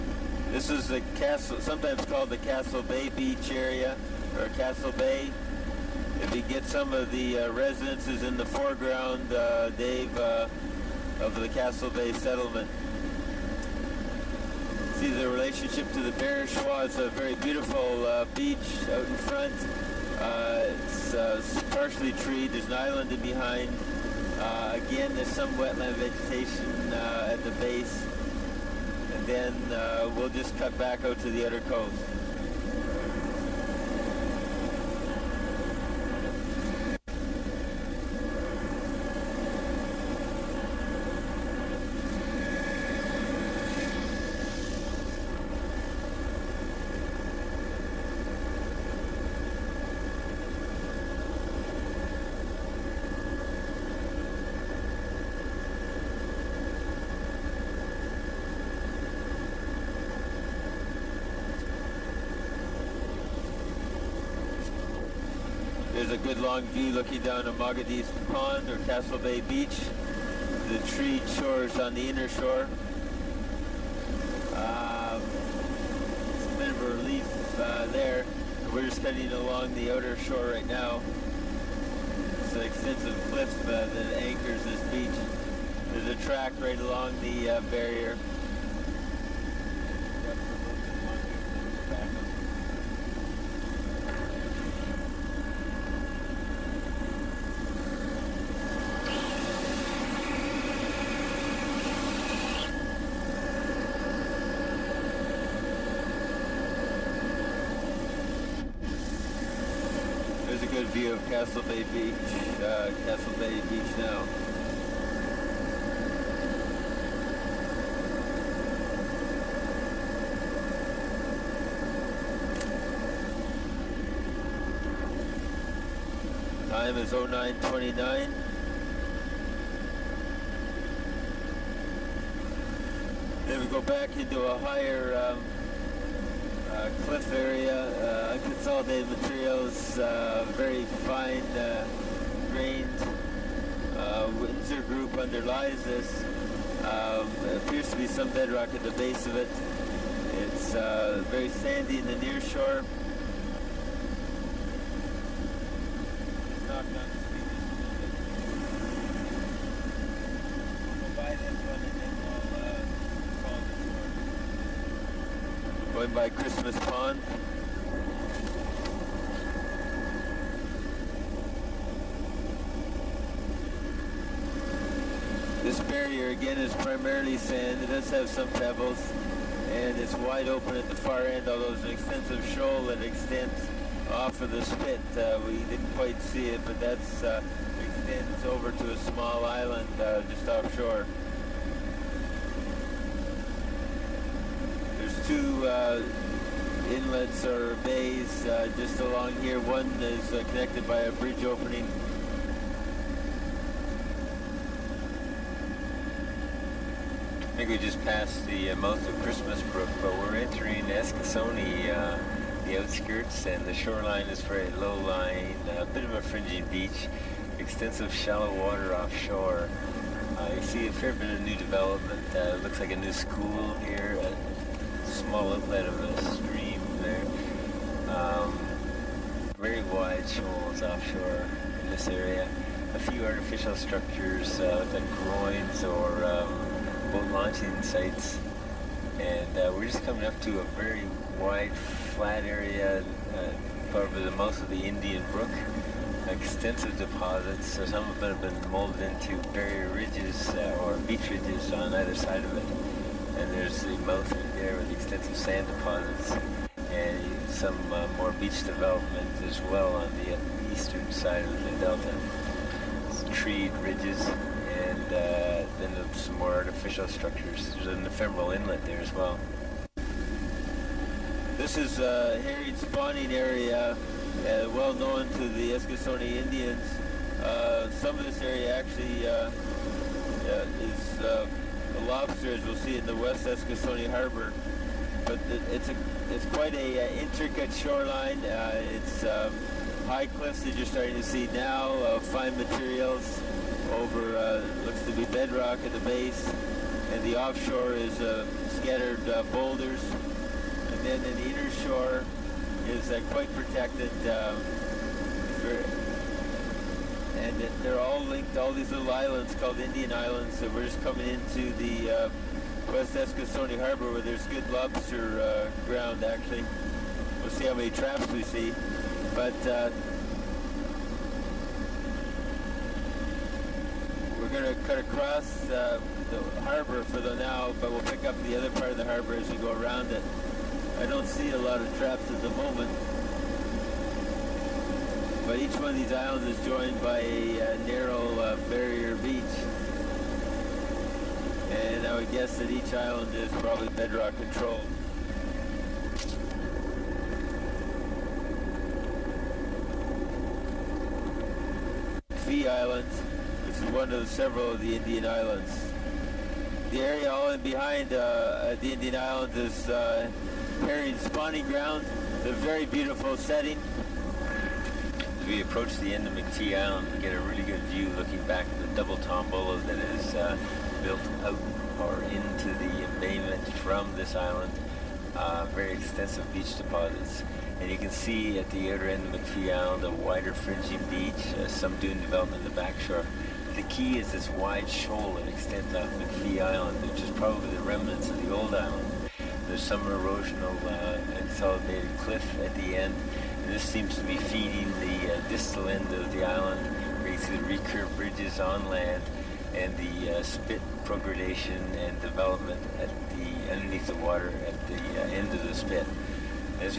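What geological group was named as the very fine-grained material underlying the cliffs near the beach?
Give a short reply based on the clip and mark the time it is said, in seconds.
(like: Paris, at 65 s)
Windsor group, at 144 s.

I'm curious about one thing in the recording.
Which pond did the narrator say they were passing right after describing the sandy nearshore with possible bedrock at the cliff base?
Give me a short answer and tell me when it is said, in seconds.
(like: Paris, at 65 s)
Christmas Pond, at 166 s.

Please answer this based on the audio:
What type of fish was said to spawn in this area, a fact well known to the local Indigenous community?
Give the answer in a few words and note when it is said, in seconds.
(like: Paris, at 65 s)
herring, at 272 s.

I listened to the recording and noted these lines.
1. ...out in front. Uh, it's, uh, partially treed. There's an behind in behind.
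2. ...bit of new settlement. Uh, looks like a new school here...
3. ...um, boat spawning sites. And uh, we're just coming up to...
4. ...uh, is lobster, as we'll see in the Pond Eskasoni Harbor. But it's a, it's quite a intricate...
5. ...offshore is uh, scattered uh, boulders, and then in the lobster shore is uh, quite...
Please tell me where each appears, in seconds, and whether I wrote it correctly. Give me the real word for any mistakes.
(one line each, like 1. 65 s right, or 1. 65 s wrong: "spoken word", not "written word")
1. 18 s wrong: "island", not "behind"
2. 221 s wrong: "development", not "settlement"
3. 236 s wrong: "launching", not "spawning"
4. 280 s wrong: "West", not "Pond"
5. 297 s wrong: "inner", not "lobster".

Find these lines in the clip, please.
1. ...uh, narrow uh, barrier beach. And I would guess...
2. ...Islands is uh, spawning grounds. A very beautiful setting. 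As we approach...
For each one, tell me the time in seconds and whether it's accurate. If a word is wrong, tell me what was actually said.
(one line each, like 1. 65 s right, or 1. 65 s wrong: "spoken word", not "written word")
1. 337 s right
2. 359 s right.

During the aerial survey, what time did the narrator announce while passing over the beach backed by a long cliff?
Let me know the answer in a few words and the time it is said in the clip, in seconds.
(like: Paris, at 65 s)
09:29, at 127 s.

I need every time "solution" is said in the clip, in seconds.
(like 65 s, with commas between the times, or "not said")
not said.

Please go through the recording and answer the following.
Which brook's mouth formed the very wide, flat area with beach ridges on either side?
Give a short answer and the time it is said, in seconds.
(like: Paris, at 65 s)
Indian Brook, at 244 s.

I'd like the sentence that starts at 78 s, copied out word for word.
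We're just heading along the outer shore right now.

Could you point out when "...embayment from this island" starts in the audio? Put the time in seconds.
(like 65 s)
373 s.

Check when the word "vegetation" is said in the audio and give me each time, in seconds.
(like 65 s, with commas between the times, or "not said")
25 s.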